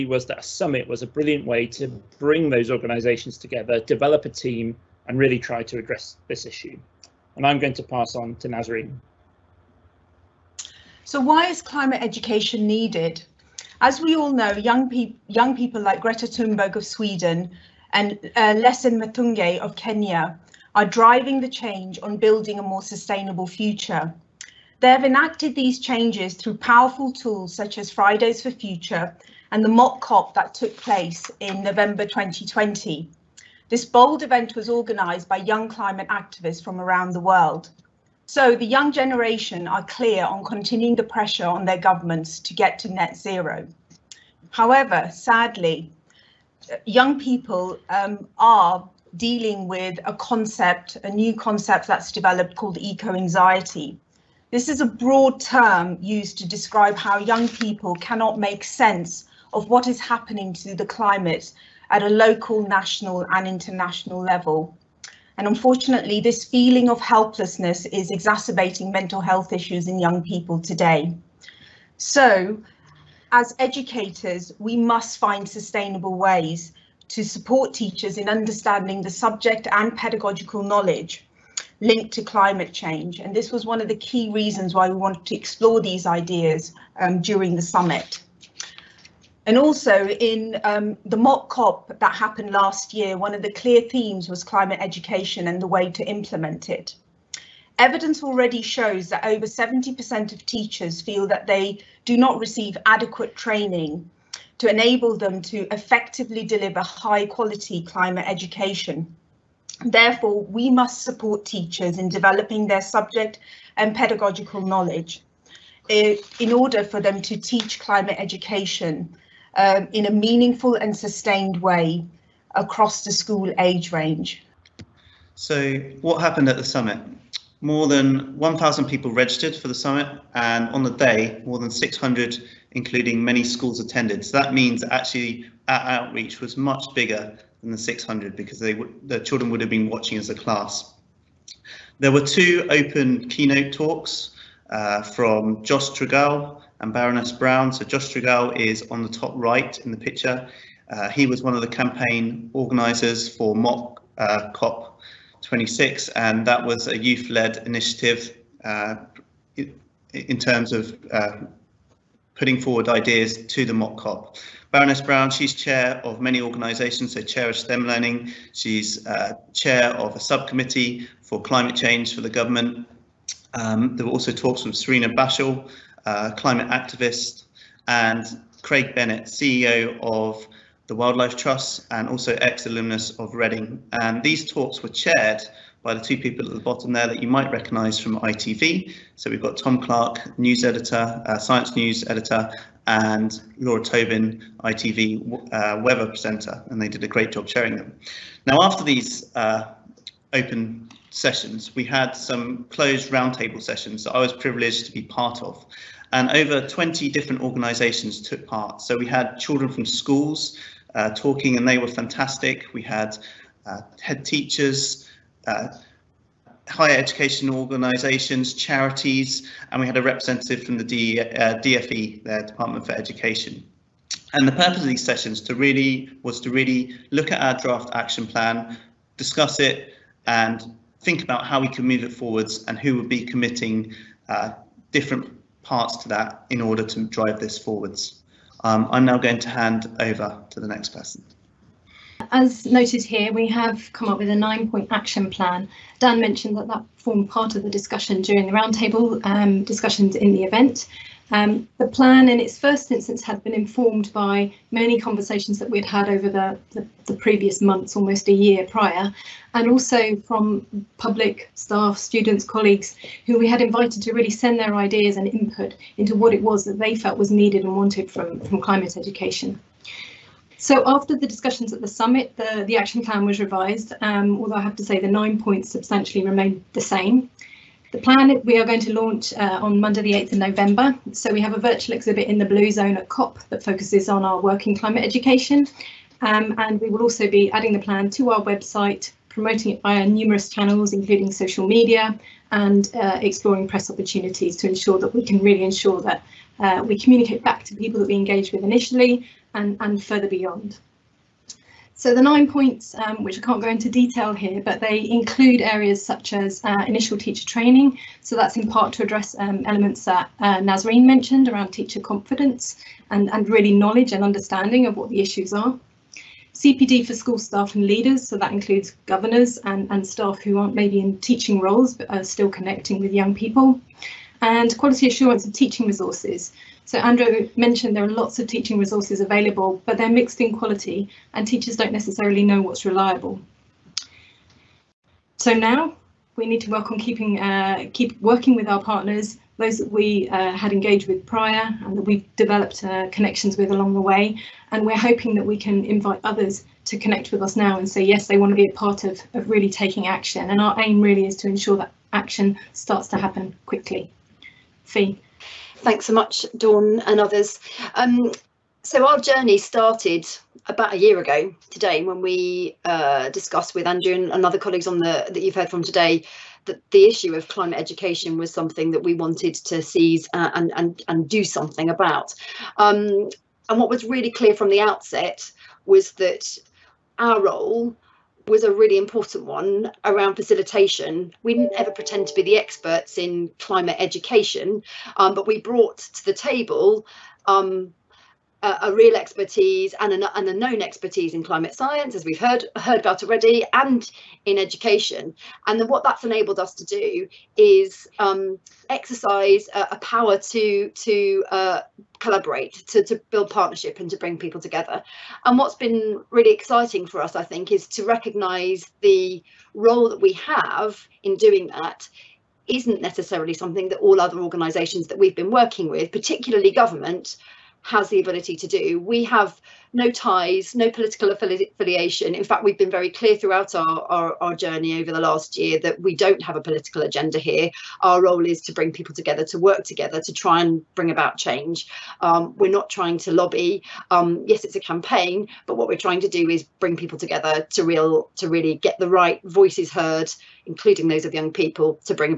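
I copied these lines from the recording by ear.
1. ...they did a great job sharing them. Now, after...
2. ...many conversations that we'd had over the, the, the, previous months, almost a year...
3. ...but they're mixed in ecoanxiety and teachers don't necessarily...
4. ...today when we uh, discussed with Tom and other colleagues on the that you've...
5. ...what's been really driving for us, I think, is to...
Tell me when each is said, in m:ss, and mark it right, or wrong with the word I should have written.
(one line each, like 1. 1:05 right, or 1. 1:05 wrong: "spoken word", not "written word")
1. 3:16 right
2. 4:14 right
3. 5:29 wrong: "quality", not "ecoanxiety"
4. 6:01 wrong: "Andrew", not "Tom"
5. 6:45 wrong: "exciting", not "driving".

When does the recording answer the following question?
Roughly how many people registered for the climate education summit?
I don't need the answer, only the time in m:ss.
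2:07.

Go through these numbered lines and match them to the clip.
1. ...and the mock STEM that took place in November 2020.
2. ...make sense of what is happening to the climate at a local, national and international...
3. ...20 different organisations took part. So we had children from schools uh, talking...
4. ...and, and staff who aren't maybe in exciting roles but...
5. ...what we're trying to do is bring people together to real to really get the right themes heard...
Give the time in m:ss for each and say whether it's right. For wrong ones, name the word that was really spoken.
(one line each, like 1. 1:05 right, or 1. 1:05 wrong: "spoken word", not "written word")
1. 0:29 wrong: "COP", not "STEM"
2. 0:58 right
3. 3:26 right
4. 5:19 wrong: "teaching", not "exciting"
5. 7:15 wrong: "voices", not "themes".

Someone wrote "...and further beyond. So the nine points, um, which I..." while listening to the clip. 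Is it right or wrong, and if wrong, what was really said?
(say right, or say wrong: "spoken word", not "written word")
right.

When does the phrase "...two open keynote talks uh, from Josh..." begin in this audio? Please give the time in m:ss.
2:22.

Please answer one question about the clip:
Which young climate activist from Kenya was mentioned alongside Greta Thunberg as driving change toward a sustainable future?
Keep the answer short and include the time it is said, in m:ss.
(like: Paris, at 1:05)
Lesein Mutunkei, at 0:18.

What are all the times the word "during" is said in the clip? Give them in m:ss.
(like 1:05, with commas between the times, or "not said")
1:27, 4:08.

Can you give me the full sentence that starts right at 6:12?
Um, and what was really clear from the outset was that our role was a really important one around facilitation.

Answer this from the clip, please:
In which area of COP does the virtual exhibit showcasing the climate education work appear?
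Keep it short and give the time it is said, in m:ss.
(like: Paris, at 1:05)
Blue Zone, at 4:42.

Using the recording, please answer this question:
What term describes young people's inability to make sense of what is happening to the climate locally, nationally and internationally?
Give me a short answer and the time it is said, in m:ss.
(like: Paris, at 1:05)
eco-anxiety, at 0:52.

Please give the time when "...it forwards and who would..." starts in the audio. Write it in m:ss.
3:52.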